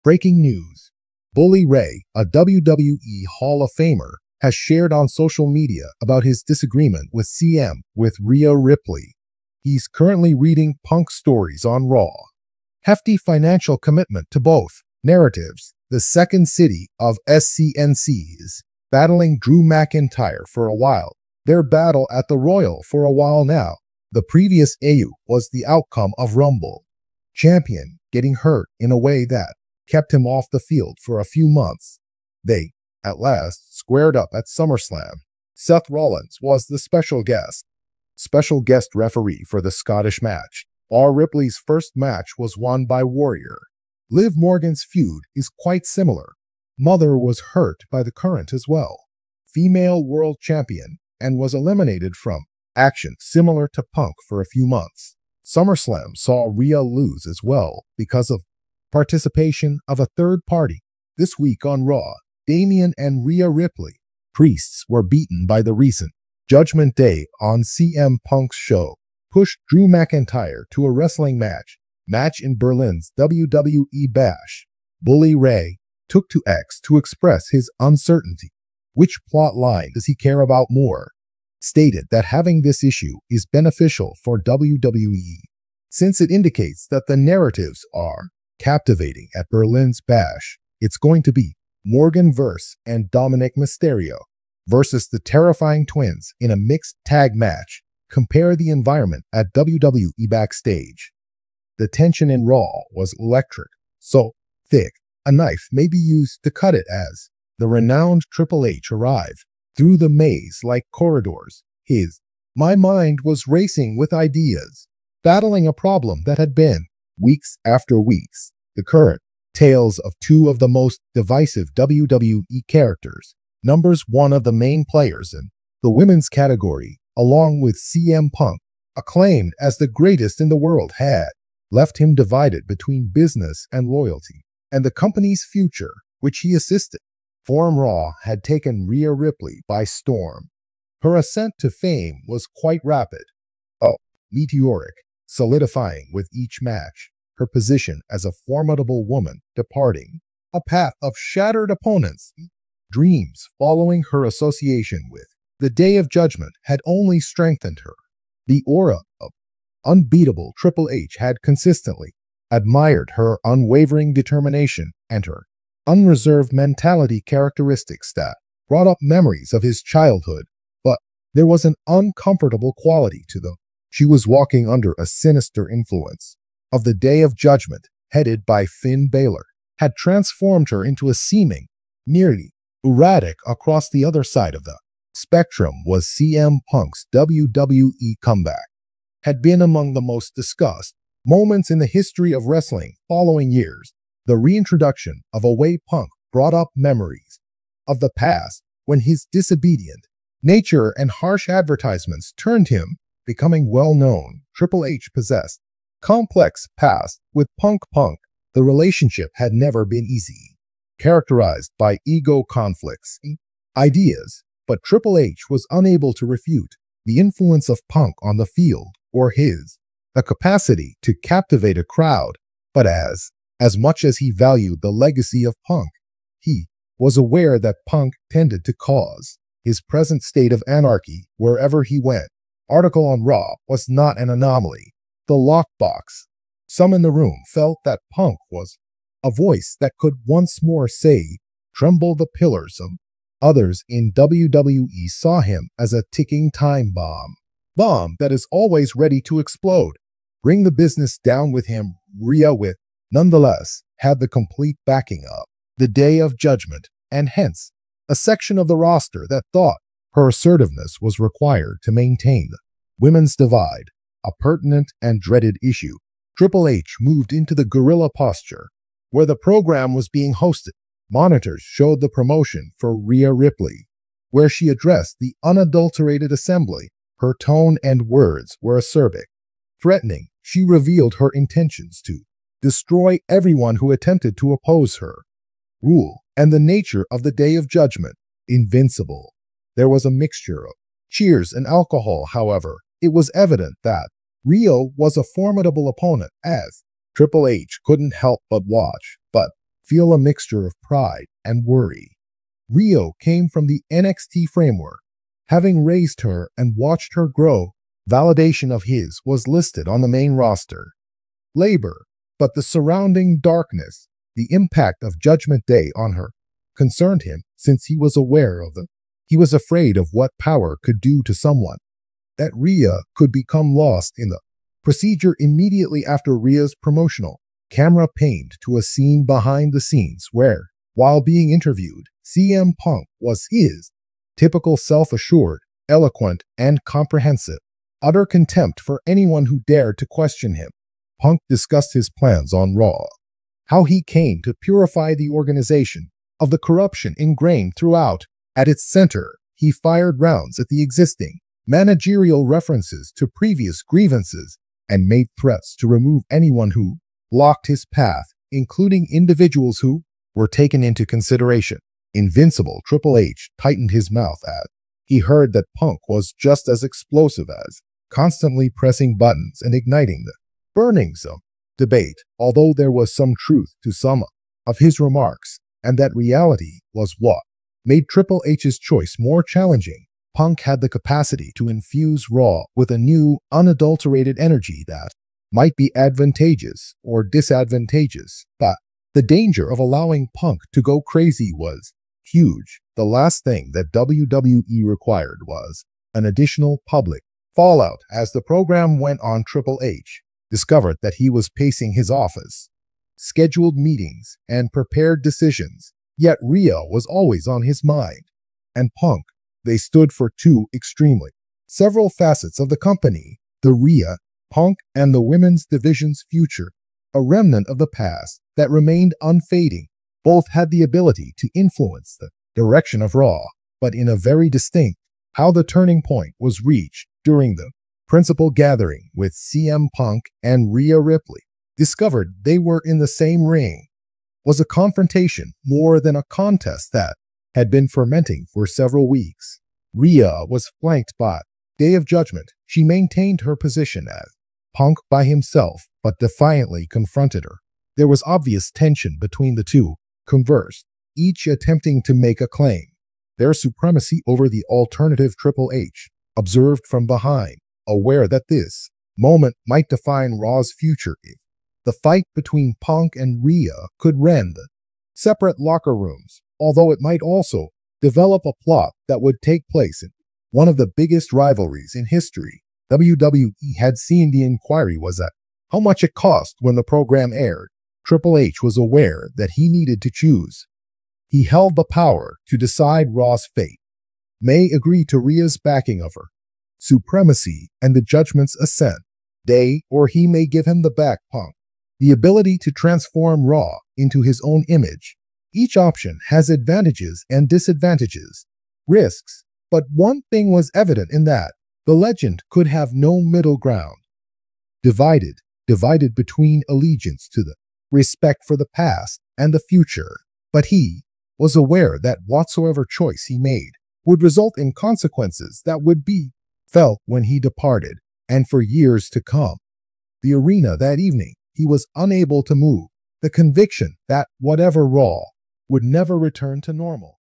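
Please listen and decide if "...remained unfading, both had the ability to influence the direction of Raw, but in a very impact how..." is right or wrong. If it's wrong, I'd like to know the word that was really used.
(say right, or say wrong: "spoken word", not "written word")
wrong: "distinct", not "impact".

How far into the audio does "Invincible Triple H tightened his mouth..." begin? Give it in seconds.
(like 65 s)
362 s.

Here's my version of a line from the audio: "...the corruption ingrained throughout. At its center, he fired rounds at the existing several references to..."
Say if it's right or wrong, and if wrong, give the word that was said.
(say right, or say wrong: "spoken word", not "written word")
wrong: "managerial", not "several".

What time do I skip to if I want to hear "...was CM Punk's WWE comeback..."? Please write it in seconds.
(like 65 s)
185 s.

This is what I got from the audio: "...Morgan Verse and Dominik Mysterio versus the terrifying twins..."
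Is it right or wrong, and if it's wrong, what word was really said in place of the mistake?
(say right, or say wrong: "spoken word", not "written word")
right.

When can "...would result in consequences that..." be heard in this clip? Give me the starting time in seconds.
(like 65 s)
514 s.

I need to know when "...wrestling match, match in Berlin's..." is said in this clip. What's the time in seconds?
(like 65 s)
70 s.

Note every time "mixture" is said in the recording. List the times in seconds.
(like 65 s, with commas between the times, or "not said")
290 s, 300 s.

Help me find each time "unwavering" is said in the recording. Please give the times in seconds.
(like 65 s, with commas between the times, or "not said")
163 s.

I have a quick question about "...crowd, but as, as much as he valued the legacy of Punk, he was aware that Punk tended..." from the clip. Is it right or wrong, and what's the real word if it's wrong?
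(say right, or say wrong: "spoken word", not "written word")
right.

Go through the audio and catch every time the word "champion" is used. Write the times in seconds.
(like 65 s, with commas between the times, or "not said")
27 s, 50 s.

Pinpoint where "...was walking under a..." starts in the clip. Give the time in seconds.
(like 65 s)
174 s.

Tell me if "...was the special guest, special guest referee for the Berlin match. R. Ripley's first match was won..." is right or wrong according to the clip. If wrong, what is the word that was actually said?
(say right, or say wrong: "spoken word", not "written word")
wrong: "Scottish", not "Berlin".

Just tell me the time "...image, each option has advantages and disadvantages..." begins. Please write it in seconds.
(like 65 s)
494 s.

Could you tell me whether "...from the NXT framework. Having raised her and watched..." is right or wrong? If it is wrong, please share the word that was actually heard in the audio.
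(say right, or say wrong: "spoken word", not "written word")
right.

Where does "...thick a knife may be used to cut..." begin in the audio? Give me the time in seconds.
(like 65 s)
104 s.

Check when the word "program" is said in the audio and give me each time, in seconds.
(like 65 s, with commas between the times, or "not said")
269 s, 398 s, 476 s.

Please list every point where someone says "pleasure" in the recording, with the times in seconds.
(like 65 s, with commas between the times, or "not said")
not said.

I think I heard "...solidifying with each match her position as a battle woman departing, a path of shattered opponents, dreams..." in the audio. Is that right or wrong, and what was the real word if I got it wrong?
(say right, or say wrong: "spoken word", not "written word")
wrong: "formidable", not "battle".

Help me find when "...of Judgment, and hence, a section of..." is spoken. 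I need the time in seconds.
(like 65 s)
256 s.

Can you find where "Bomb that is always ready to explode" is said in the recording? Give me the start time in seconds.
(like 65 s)
247 s.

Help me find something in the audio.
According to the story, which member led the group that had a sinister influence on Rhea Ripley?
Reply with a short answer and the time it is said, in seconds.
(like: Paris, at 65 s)
Finn Balor, at 178 s.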